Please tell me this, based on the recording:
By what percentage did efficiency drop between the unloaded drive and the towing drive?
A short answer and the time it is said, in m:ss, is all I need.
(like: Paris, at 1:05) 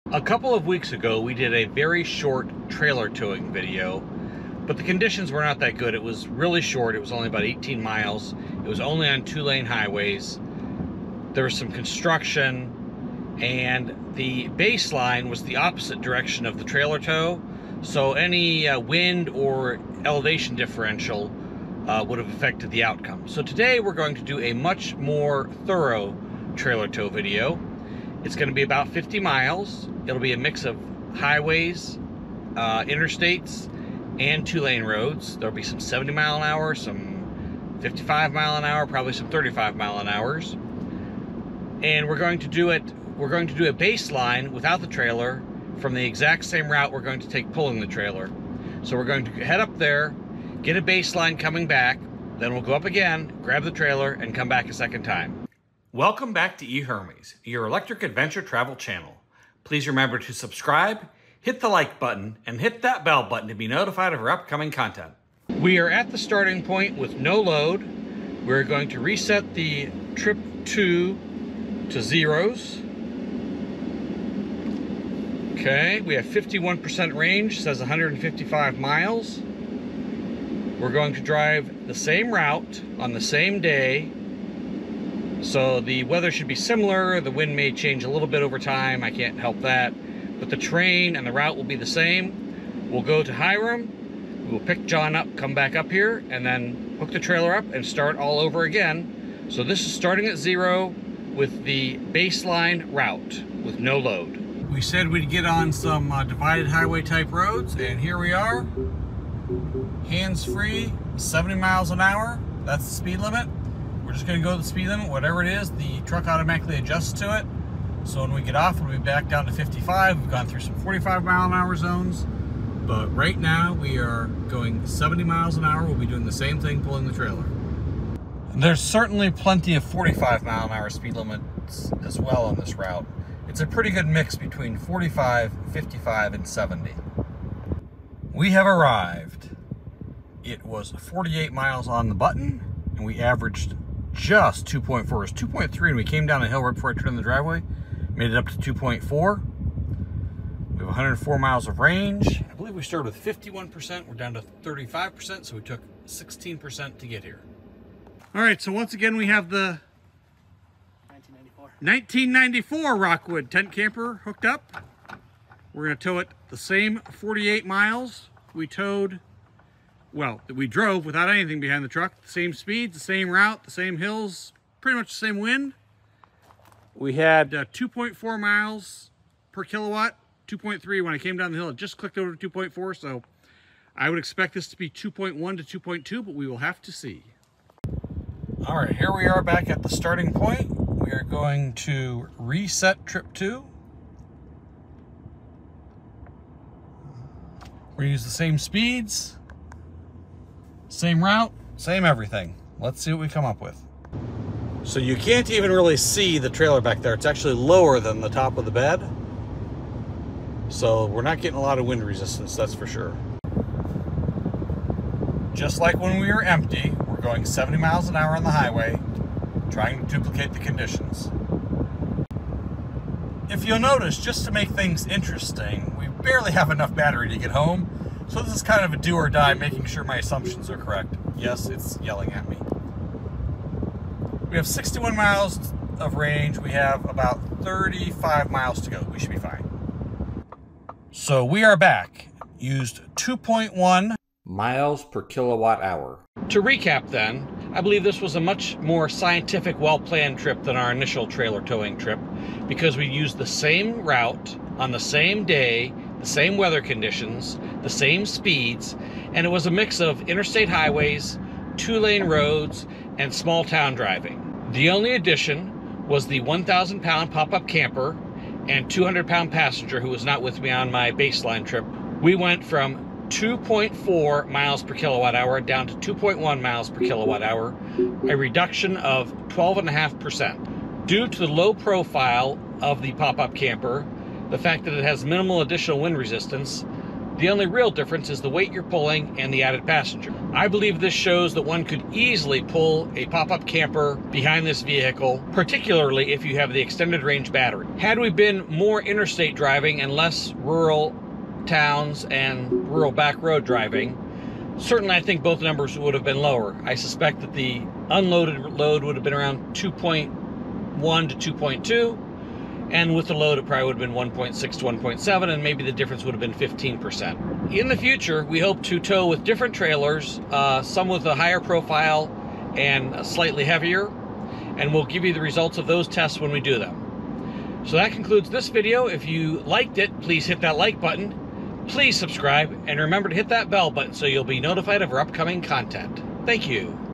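12.5%, at 4:39.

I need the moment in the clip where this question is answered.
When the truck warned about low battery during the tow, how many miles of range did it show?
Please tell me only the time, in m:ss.
3:54.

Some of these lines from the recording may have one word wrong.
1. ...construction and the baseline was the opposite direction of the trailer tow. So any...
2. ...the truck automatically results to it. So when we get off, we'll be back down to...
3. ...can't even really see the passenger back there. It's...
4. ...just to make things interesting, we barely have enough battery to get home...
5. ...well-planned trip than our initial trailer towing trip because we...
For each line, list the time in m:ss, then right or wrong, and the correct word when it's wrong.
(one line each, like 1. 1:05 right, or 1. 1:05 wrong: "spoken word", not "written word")
1. 0:11 right
2. 1:55 wrong: "adjusts", not "results"
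3. 3:25 wrong: "trailer", not "passenger"
4. 3:44 right
5. 4:09 right.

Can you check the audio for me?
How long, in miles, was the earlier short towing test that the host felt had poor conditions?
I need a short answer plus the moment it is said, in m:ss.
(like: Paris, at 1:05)
18, at 0:07.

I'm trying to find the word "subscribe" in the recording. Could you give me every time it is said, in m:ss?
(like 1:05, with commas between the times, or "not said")
1:00, 5:32.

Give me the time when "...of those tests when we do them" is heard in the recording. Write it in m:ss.
5:25.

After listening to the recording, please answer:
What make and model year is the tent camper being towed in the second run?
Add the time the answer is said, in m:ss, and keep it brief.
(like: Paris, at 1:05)
1994 Rockwood, at 2:41.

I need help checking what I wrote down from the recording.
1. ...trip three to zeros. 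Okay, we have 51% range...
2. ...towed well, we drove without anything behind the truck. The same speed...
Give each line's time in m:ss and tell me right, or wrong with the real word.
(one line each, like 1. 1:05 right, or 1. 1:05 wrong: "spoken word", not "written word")
1. 1:10 wrong: "two", not "three"
2. 2:48 right.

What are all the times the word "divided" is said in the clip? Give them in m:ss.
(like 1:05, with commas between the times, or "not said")
1:46.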